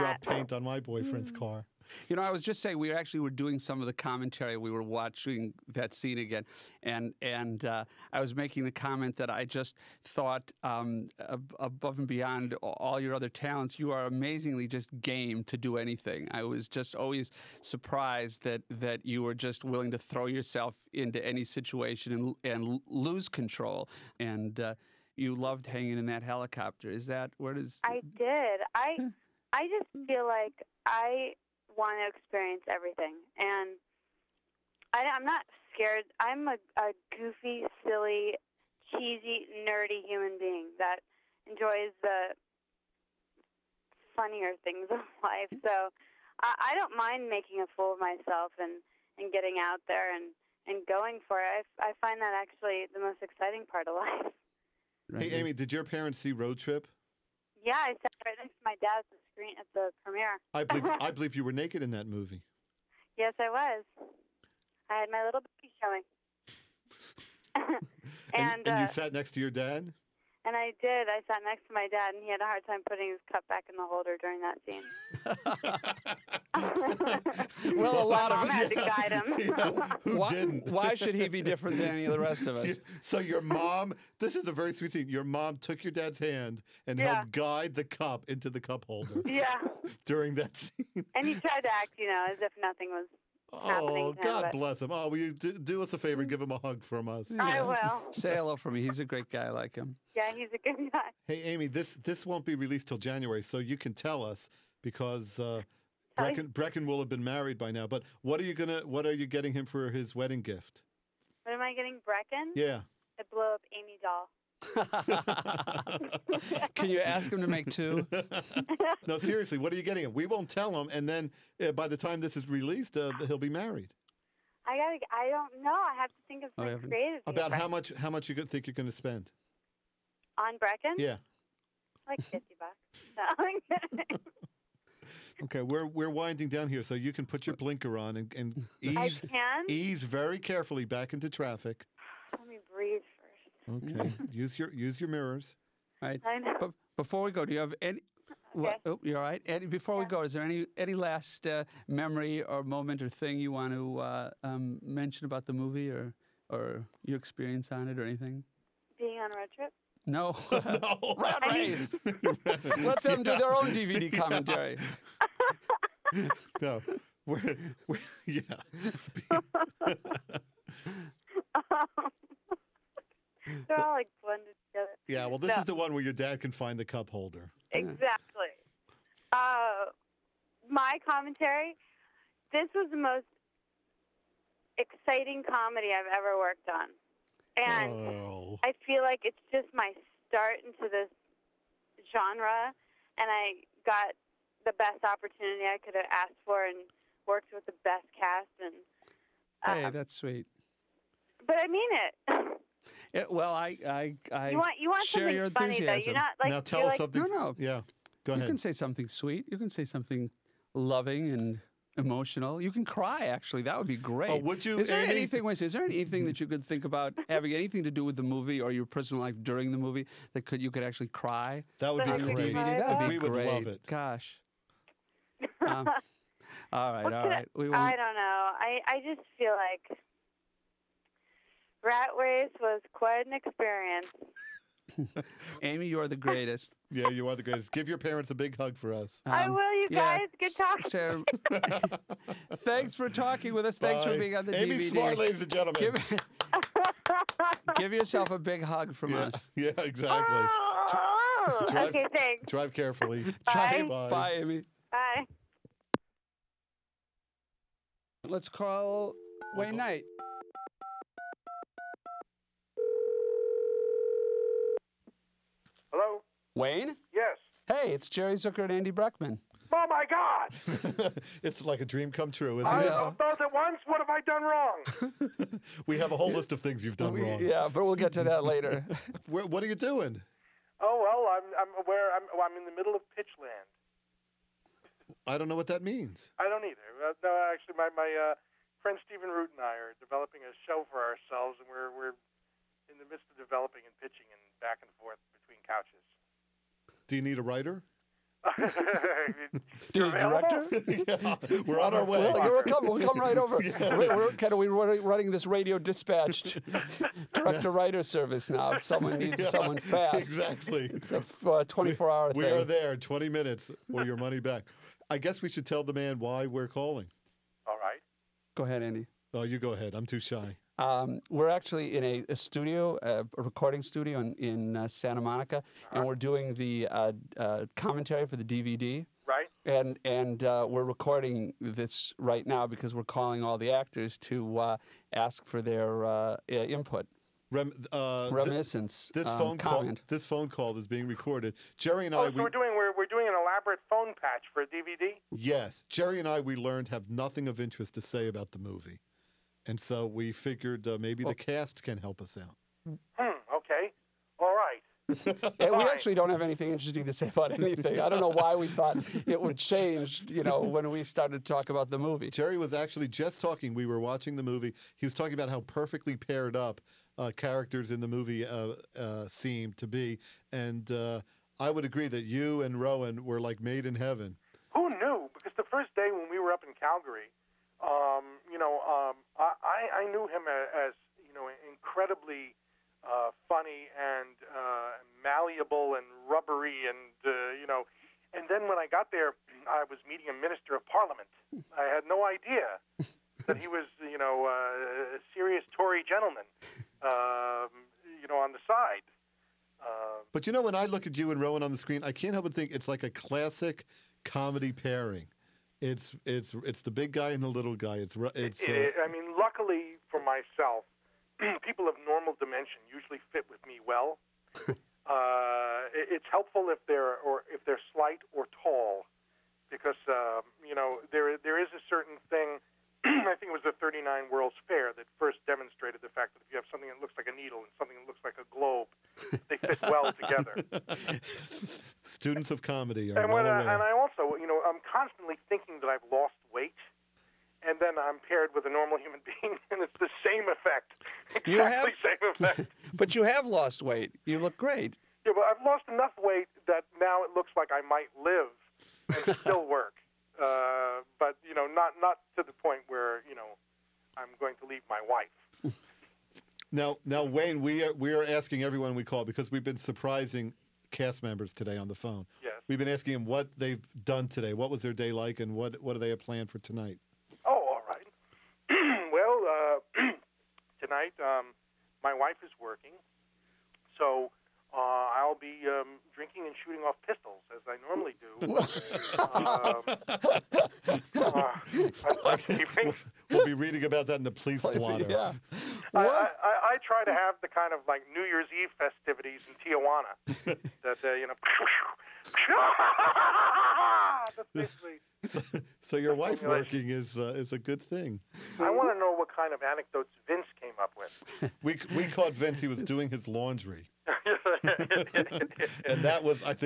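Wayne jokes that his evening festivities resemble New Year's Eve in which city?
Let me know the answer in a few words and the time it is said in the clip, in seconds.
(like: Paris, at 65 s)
Tijuana, at 489 s.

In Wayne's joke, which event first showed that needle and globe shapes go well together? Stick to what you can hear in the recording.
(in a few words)
The 39 World's Fair.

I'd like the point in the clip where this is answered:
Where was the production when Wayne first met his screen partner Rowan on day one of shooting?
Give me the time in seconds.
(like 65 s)
376 s.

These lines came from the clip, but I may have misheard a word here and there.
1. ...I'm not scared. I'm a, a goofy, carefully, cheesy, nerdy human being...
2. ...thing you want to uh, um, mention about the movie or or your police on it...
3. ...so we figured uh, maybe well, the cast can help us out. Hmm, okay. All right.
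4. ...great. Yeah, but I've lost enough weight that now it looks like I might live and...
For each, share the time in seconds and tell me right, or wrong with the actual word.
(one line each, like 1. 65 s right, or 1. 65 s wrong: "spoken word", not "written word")
1. 35 s wrong: "silly", not "carefully"
2. 153 s wrong: "experience", not "police"
3. 349 s right
4. 444 s right.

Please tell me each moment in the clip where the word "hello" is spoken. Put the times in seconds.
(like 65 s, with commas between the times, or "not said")
98 s, 265 s.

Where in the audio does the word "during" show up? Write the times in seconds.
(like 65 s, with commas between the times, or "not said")
74 s, 90 s, 219 s.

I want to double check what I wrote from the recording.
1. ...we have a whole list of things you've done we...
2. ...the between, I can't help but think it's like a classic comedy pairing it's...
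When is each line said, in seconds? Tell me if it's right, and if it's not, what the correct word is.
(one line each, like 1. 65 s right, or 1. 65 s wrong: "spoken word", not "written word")
1. 275 s right
2. 401 s wrong: "screen", not "between".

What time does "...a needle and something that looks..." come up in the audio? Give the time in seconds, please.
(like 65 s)
427 s.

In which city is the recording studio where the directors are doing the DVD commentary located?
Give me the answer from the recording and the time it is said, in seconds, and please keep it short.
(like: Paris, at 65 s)
Santa Monica, at 324 s.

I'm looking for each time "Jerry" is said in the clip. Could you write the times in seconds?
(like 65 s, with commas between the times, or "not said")
268 s, 341 s, 345 s, 362 s.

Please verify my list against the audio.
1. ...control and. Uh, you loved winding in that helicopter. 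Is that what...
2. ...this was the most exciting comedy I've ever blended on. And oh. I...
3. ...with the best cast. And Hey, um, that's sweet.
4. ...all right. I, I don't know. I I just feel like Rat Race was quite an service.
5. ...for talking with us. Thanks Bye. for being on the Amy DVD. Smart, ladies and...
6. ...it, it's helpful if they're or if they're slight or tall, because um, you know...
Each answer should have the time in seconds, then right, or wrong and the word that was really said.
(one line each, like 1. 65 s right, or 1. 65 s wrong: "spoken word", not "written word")
1. 23 s wrong: "hanging", not "winding"
2. 182 s wrong: "worked", not "blended"
3. 197 s right
4. 227 s wrong: "experience", not "service"
5. 242 s right
6. 415 s right.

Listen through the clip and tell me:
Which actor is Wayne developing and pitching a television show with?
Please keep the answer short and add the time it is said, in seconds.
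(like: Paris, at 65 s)
Stephen Root, at 289 s.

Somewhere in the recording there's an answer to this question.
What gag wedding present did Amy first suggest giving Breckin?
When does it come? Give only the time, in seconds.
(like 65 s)
113 s.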